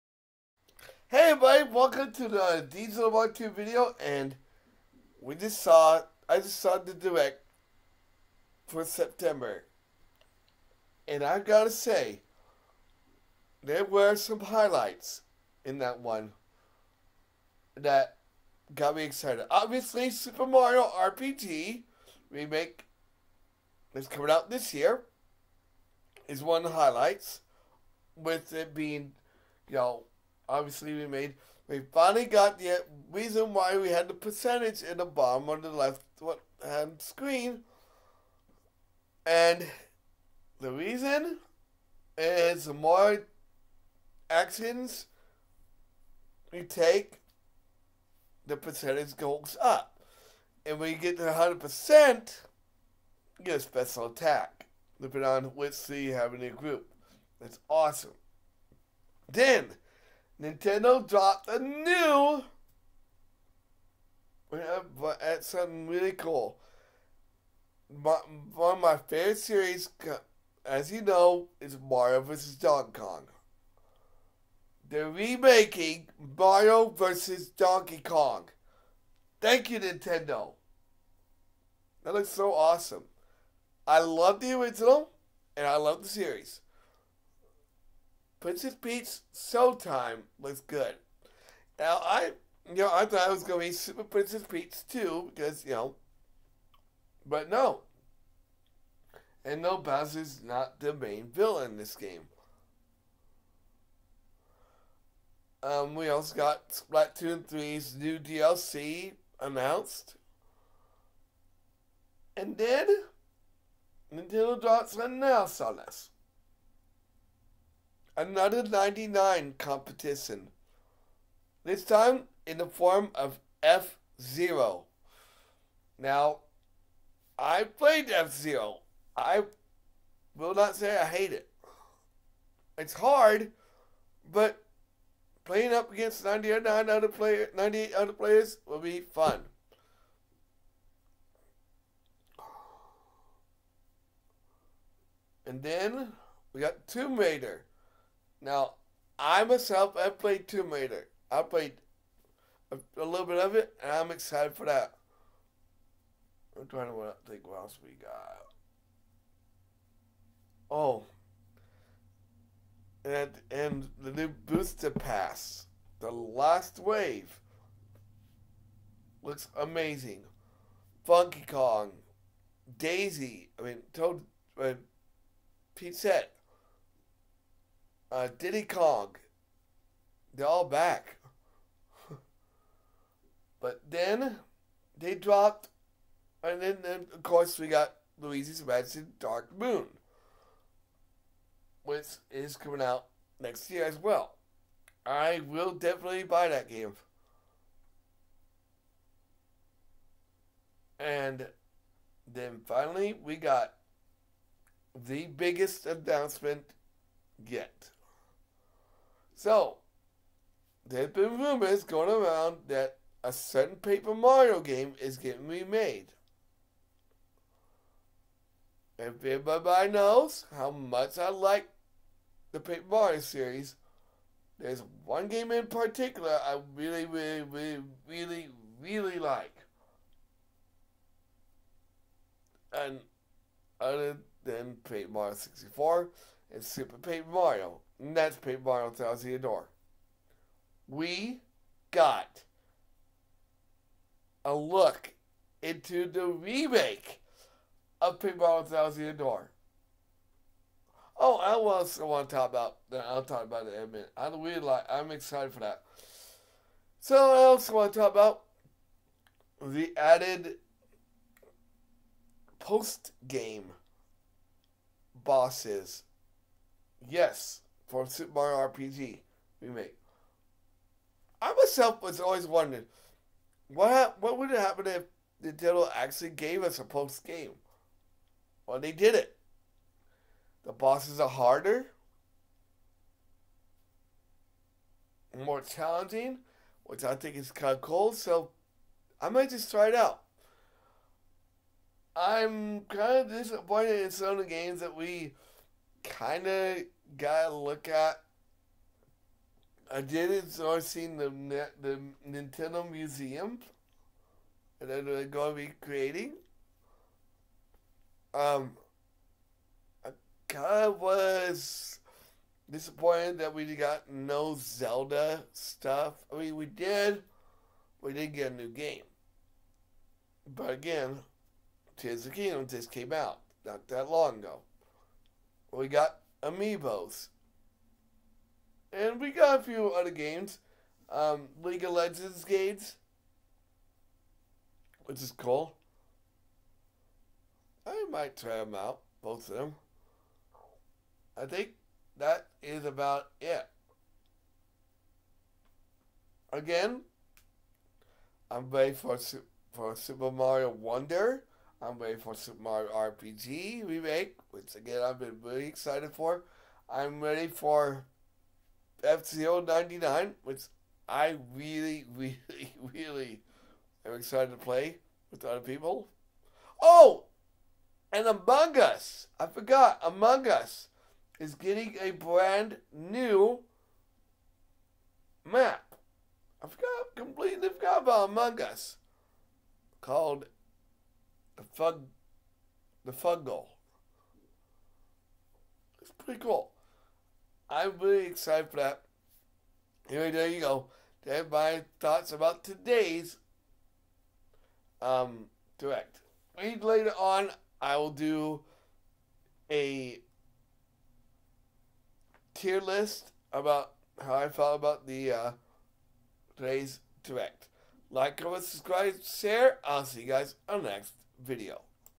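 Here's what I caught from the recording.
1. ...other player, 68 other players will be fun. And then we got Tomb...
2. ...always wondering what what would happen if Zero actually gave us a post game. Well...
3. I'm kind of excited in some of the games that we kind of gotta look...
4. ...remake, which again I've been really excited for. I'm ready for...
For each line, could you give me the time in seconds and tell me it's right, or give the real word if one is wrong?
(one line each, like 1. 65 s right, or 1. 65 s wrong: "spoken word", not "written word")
1. 136 s wrong: "98", not "68"
2. 272 s wrong: "Nintendo", not "Zero"
3. 292 s wrong: "disappointed", not "excited"
4. 353 s right.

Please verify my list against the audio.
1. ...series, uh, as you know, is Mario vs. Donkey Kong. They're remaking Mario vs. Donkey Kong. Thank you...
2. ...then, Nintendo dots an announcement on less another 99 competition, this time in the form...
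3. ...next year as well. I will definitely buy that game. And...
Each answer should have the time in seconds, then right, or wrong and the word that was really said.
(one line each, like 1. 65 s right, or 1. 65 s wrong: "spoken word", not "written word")
1. 69 s right
2. 112 s right
3. 193 s right.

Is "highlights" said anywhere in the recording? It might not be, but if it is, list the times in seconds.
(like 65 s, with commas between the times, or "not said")
14 s, 26 s.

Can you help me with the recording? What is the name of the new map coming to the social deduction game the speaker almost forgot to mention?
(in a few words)
the Fungle.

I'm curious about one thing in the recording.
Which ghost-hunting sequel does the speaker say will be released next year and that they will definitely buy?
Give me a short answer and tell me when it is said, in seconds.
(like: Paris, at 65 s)
Luigi's Mansion Dark Moon, at 188 s.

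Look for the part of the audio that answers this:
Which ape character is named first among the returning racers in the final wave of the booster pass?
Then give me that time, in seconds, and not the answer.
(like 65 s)
171 s.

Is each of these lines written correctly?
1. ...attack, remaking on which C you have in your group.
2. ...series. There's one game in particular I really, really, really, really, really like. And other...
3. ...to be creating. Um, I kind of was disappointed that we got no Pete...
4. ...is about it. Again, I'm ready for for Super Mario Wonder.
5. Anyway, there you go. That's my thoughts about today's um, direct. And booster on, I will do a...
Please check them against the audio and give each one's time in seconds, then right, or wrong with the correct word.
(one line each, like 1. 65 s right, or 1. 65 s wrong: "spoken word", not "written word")
1. 54 s wrong: "depending", not "remaking"
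2. 223 s right
3. 305 s wrong: "Zelda", not "Pete"
4. 342 s right
5. 390 s wrong: "later", not "booster".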